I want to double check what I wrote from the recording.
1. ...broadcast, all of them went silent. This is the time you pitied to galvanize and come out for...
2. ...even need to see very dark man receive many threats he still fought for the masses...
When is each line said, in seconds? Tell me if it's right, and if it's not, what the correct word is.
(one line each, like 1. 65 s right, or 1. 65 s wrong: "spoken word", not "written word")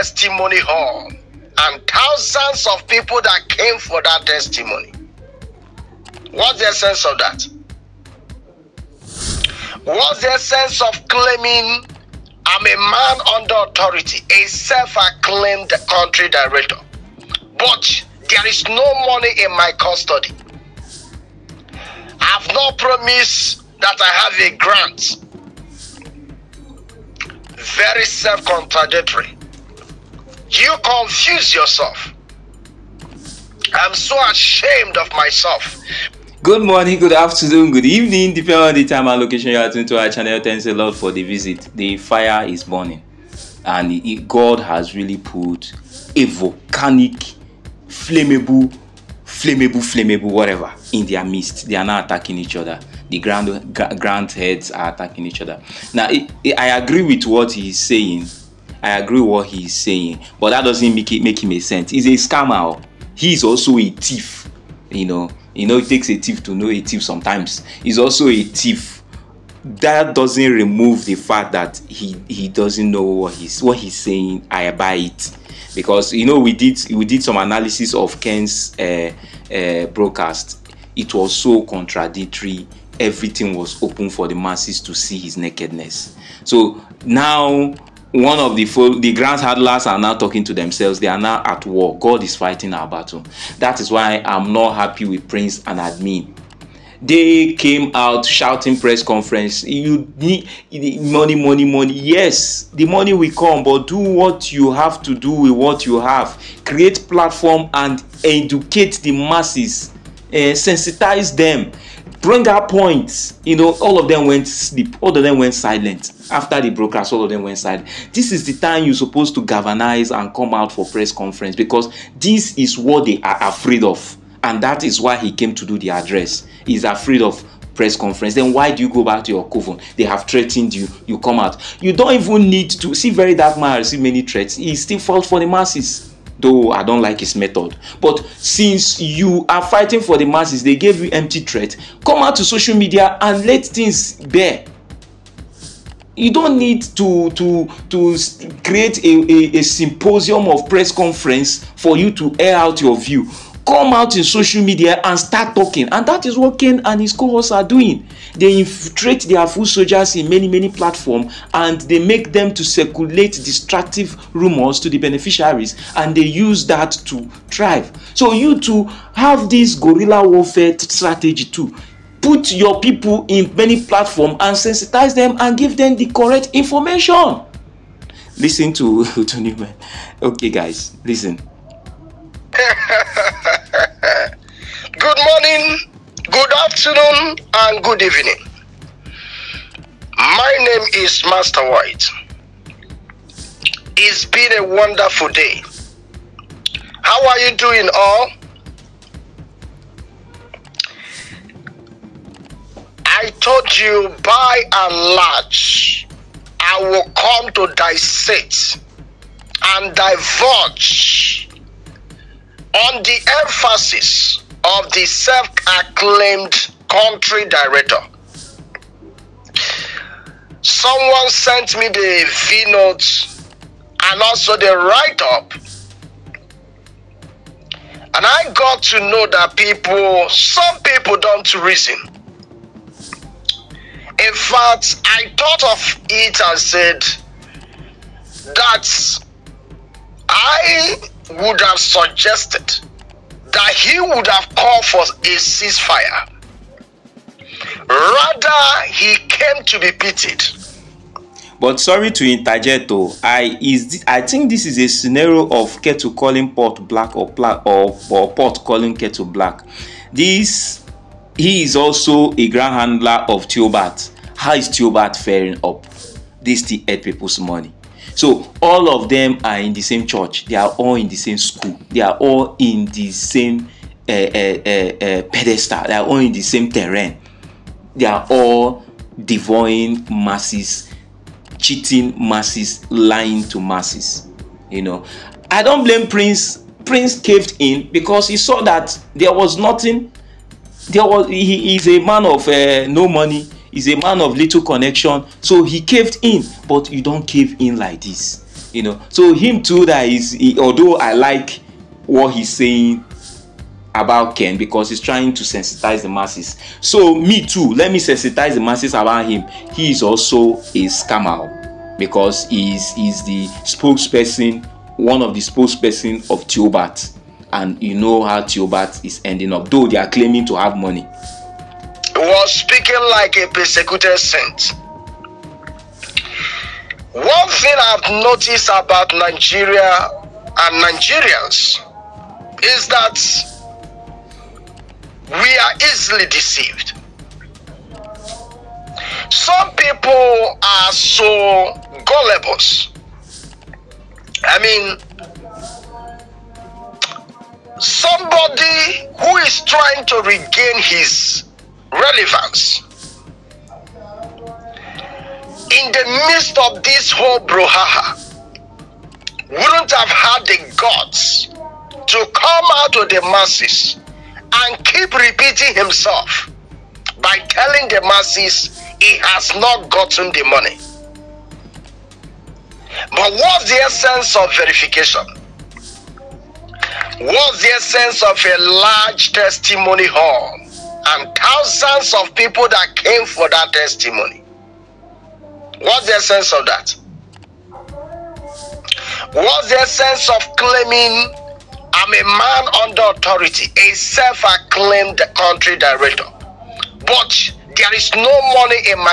1. 116 s wrong: "supposed", not "pitied"
2. 132 s right.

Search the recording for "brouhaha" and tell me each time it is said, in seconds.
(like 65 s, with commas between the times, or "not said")
357 s.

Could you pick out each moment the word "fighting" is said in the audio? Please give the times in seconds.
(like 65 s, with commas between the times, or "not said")
92 s, 139 s.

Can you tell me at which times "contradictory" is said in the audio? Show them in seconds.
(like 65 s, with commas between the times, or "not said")
28 s, 81 s.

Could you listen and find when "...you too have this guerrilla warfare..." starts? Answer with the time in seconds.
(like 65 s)
168 s.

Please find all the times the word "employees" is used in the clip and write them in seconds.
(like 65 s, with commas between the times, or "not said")
not said.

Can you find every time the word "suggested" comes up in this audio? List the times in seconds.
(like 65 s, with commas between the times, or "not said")
241 s.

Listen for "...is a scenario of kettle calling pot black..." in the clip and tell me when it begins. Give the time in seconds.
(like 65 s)
254 s.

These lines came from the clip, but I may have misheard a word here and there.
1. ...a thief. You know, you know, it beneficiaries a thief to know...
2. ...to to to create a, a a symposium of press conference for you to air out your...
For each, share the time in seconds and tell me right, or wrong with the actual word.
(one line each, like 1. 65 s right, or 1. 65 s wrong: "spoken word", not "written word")
1. 63 s wrong: "takes", not "beneficiaries"
2. 146 s right.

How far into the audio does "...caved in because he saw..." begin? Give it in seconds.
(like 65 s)
287 s.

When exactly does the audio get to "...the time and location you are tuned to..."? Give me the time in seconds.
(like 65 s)
38 s.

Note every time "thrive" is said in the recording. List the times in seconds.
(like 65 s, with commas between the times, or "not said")
167 s.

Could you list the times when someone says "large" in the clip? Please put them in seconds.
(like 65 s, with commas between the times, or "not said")
205 s, 378 s.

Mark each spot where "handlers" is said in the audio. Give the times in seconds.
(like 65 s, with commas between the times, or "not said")
89 s, 262 s.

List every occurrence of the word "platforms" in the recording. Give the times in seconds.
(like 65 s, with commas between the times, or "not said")
107 s, 160 s, 173 s.